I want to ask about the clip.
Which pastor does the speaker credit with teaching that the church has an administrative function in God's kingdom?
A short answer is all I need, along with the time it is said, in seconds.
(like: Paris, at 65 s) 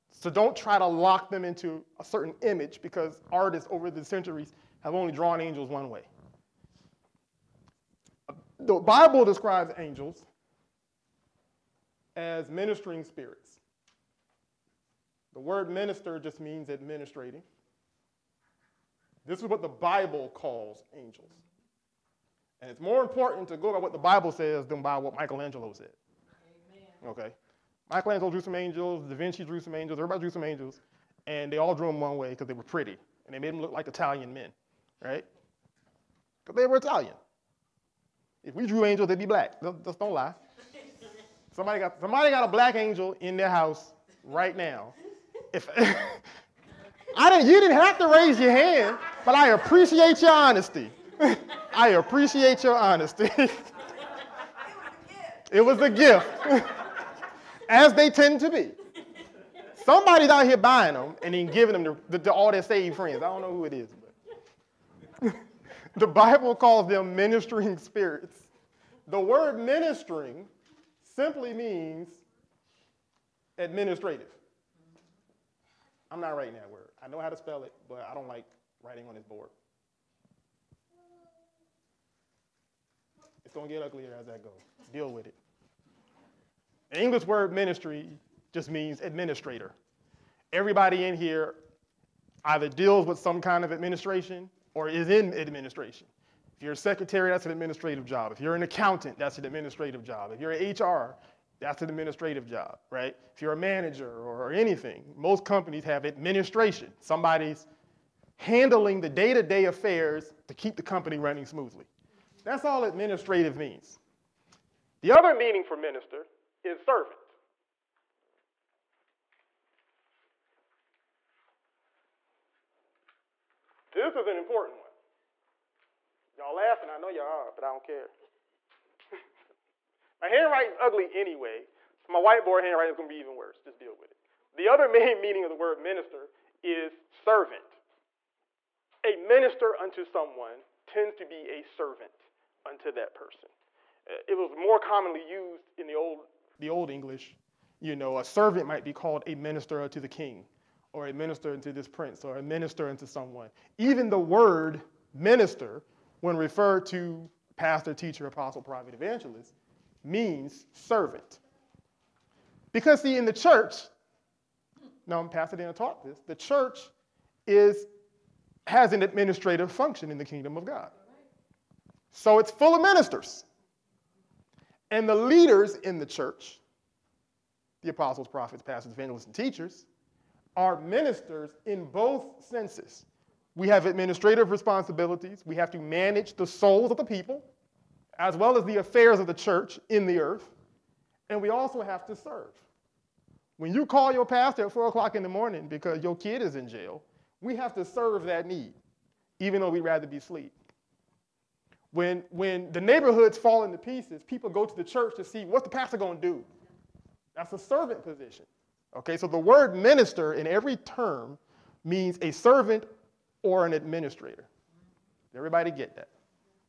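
Pastor Diana, at 165 s.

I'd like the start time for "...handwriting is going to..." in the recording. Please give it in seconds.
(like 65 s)
132 s.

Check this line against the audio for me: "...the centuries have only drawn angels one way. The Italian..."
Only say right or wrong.
wrong.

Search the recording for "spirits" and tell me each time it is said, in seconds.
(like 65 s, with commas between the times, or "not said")
13 s, 67 s.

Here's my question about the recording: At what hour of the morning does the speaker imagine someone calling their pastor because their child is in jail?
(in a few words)
4 o'clock.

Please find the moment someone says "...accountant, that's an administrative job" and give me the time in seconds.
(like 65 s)
98 s.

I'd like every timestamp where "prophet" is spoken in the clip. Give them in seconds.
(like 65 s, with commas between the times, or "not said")
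158 s, 178 s.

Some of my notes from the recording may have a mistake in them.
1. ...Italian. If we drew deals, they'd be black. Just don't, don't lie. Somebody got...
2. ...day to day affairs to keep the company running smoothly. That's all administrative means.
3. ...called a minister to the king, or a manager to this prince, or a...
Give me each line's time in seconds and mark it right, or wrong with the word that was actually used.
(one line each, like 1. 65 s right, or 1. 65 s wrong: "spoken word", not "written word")
1. 36 s wrong: "angels", not "deals"
2. 109 s right
3. 148 s wrong: "minister", not "manager".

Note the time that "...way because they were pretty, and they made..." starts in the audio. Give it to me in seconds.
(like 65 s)
32 s.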